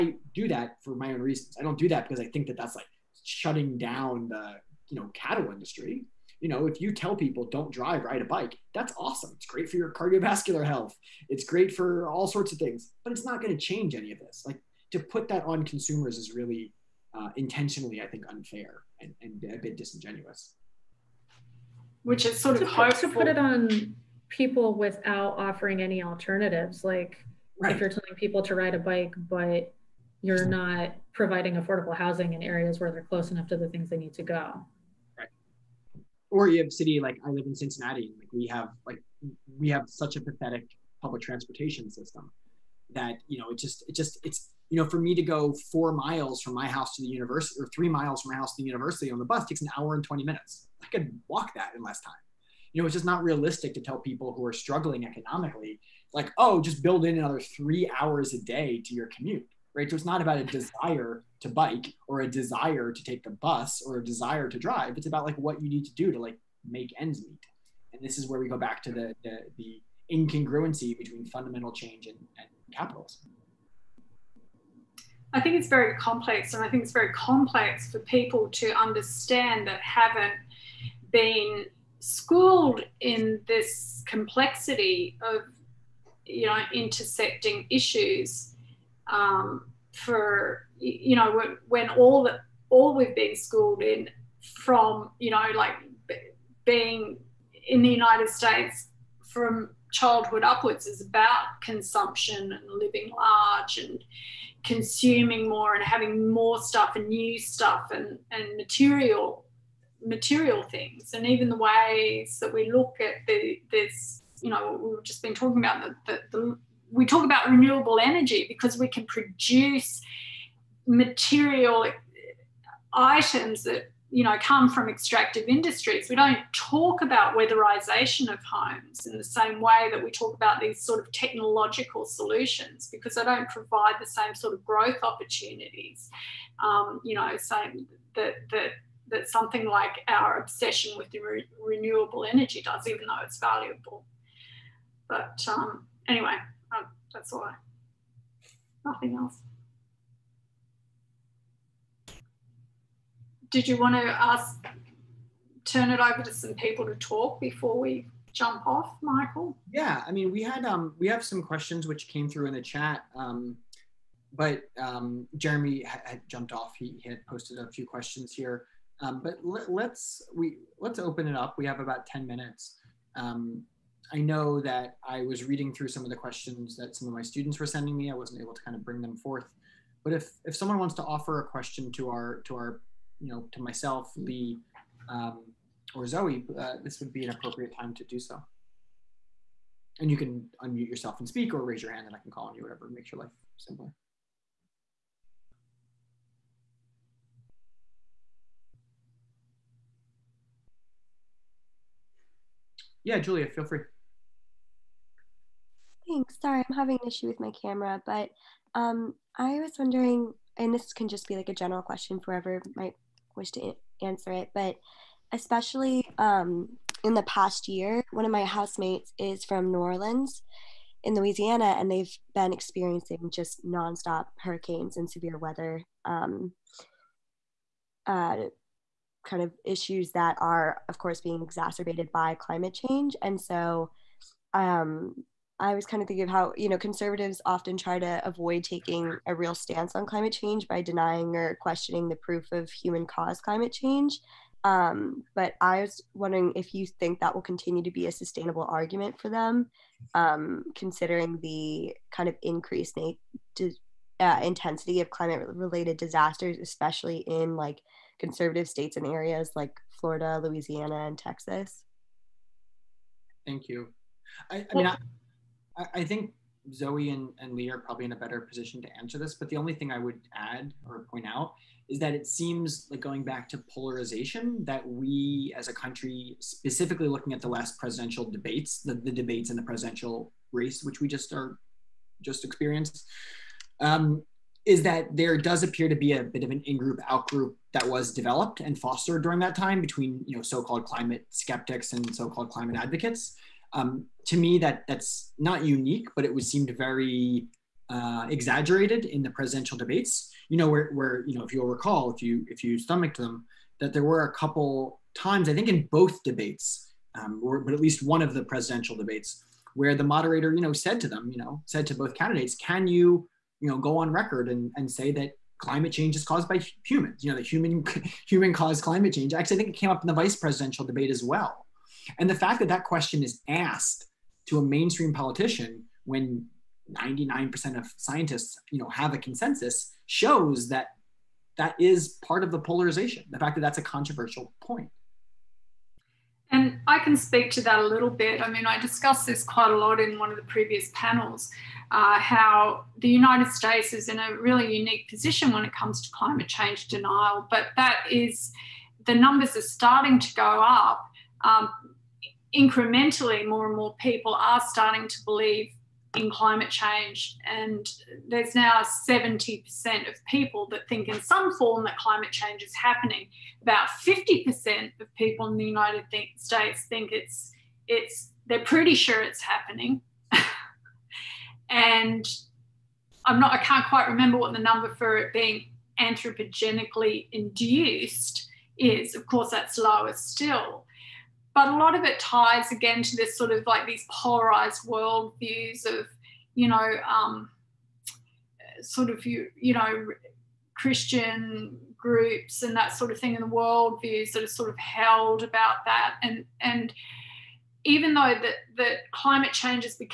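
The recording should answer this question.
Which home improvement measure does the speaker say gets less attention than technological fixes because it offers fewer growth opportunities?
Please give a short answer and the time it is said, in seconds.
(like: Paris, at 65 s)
weatherization, at 127 s.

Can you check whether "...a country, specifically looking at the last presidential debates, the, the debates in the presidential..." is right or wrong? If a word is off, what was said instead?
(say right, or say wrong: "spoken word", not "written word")
right.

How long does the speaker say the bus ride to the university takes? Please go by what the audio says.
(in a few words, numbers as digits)
an hour and 20 minutes.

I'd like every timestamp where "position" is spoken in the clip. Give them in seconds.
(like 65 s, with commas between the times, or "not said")
268 s, 345 s.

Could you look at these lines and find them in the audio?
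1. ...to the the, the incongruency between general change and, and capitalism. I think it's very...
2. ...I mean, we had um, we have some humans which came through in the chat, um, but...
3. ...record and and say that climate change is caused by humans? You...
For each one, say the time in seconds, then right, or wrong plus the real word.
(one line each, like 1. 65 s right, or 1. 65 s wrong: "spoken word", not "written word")
1. 68 s wrong: "fundamental", not "general"
2. 160 s wrong: "questions", not "humans"
3. 314 s right.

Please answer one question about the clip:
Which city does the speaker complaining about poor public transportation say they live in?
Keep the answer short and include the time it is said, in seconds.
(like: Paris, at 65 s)
Cincinnati, at 37 s.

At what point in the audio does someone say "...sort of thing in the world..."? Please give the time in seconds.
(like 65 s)
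392 s.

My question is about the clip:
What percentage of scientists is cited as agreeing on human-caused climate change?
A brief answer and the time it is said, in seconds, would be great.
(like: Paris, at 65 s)
99%, at 326 s.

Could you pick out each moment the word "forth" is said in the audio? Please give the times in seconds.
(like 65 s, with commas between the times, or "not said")
179 s.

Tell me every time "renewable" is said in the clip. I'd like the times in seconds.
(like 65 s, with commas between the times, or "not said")
117 s, 141 s.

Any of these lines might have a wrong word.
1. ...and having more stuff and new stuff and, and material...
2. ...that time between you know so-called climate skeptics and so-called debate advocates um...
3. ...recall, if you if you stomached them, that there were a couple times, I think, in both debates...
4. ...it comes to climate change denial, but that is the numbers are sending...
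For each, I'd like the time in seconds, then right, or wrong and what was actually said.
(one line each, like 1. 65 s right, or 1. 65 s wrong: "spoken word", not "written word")
1. 105 s right
2. 289 s wrong: "climate", not "debate"
3. 301 s right
4. 345 s wrong: "starting", not "sending".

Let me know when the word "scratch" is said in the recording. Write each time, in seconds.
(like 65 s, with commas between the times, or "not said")
not said.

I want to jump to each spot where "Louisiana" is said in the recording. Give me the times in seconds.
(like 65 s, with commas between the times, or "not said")
221 s, 260 s.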